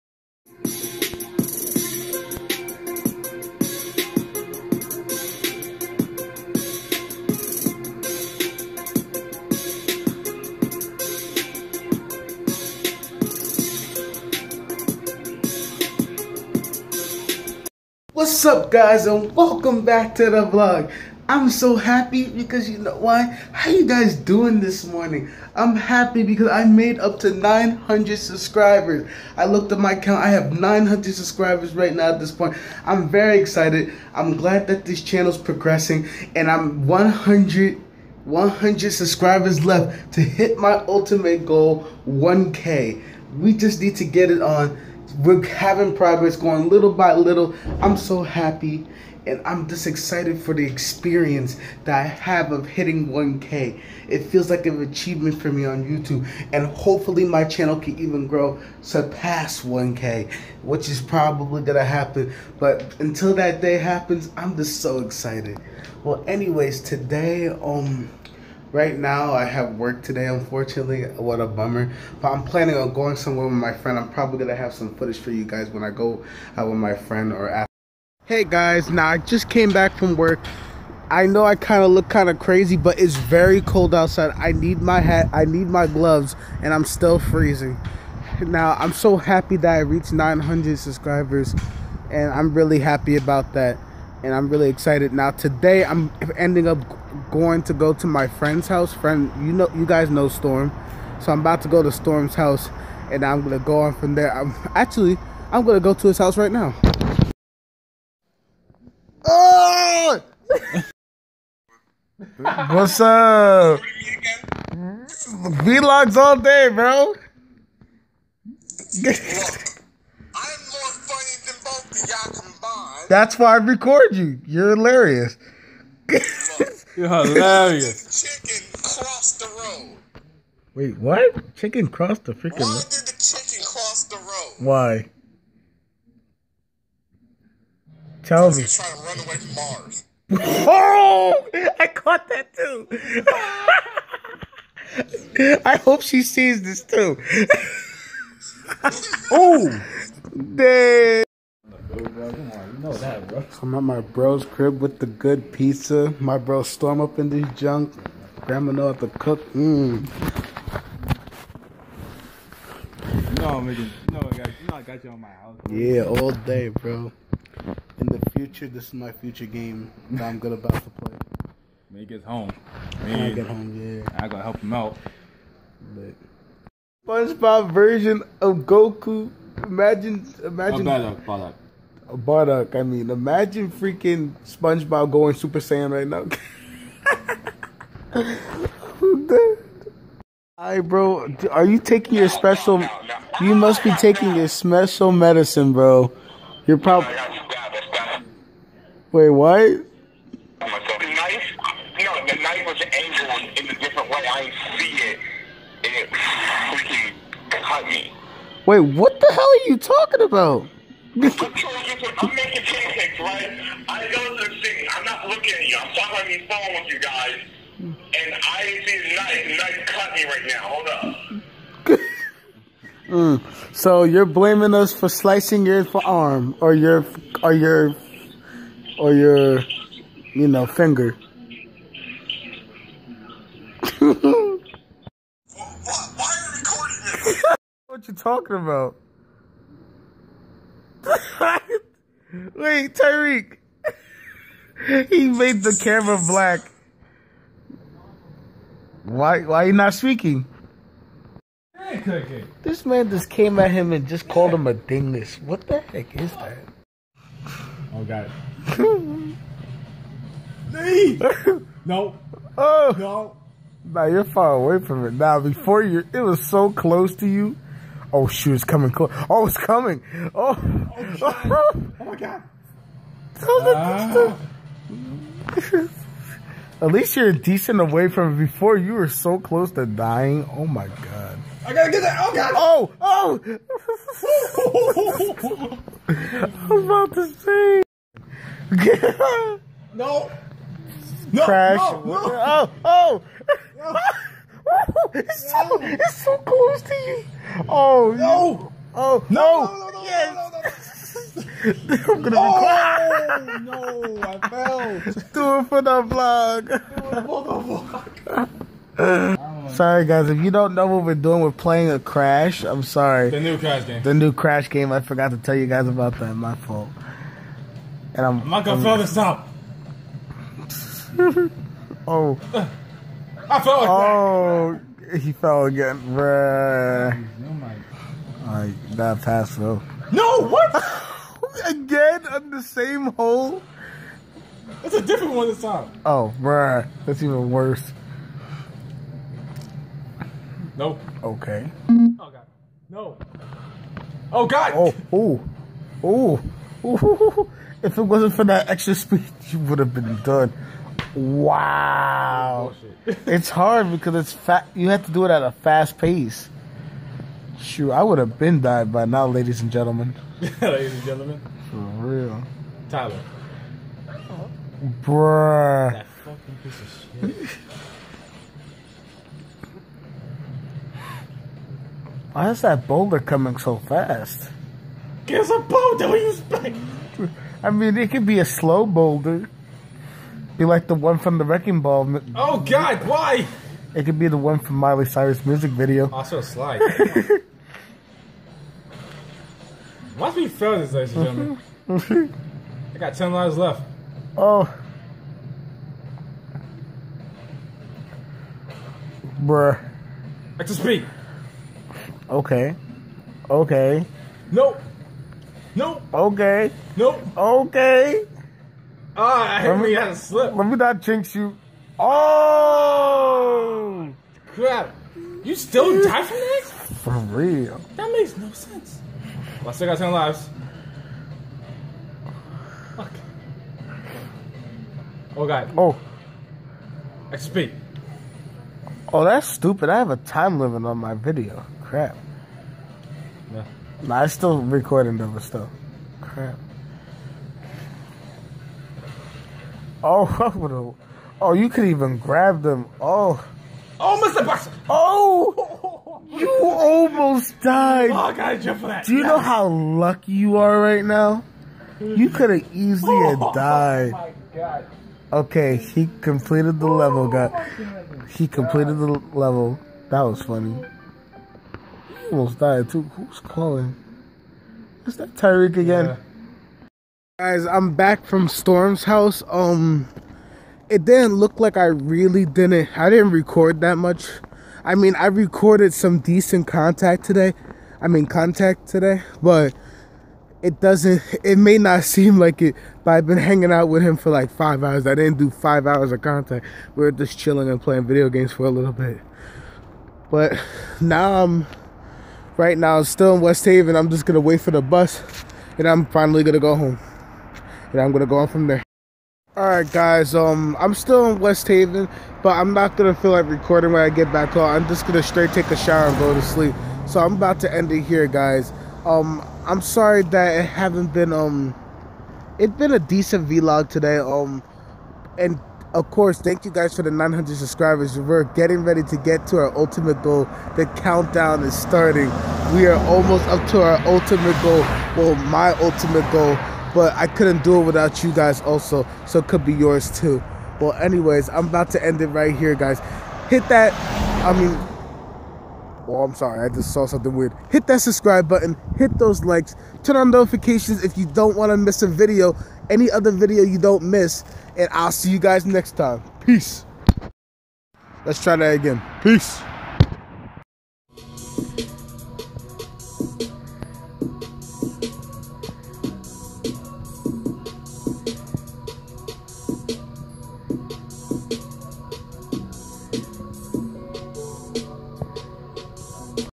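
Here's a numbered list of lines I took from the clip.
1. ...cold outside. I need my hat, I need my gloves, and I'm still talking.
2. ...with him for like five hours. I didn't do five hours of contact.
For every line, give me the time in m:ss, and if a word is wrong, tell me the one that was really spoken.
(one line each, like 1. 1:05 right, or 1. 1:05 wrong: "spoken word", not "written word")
1. 1:23 wrong: "freezing", not "talking"
2. 8:03 right.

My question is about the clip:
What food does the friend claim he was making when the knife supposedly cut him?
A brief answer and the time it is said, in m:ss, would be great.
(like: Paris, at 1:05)
Pancakes, at 3:31.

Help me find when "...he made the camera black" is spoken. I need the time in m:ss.
4:05.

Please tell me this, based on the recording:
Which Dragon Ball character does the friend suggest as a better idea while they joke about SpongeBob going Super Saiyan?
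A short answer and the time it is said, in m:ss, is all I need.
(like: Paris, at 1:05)
Bardock, at 3:02.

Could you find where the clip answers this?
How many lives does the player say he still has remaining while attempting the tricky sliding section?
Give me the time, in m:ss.
6:33.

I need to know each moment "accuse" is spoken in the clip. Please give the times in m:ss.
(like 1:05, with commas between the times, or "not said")
not said.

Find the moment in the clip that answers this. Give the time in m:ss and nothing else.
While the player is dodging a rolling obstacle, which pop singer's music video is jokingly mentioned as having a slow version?
6:24.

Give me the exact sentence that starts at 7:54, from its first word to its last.
I mean, I recorded some decent contact today.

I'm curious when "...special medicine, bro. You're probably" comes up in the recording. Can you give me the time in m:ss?
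3:14.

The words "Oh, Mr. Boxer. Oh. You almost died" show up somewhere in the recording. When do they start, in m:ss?
7:23.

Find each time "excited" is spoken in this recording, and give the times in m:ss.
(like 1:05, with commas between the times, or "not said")
0:33, 0:49, 1:05, 1:34.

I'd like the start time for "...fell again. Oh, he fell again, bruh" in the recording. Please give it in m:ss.
5:23.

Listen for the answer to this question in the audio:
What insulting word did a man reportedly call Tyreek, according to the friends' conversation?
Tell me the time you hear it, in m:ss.
4:14.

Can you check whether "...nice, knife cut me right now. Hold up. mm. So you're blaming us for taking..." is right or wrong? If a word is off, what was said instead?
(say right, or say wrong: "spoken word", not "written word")
wrong: "slicing", not "taking".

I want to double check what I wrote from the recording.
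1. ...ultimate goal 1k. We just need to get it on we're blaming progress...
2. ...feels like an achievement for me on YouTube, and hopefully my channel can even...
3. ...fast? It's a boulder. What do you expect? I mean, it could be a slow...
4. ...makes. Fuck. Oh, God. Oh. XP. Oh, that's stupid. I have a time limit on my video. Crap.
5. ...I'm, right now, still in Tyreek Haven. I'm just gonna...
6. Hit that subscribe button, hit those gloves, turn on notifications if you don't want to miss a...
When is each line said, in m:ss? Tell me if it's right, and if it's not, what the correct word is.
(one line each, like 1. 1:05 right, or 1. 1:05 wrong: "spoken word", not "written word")
1. 0:40 wrong: "having", not "blaming"
2. 0:54 right
3. 6:13 right
4. 7:00 wrong: "lives", not "makes"
5. 8:11 wrong: "West", not "Tyreek"
6. 8:57 wrong: "likes", not "gloves".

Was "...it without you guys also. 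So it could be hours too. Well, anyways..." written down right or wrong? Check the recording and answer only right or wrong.
wrong.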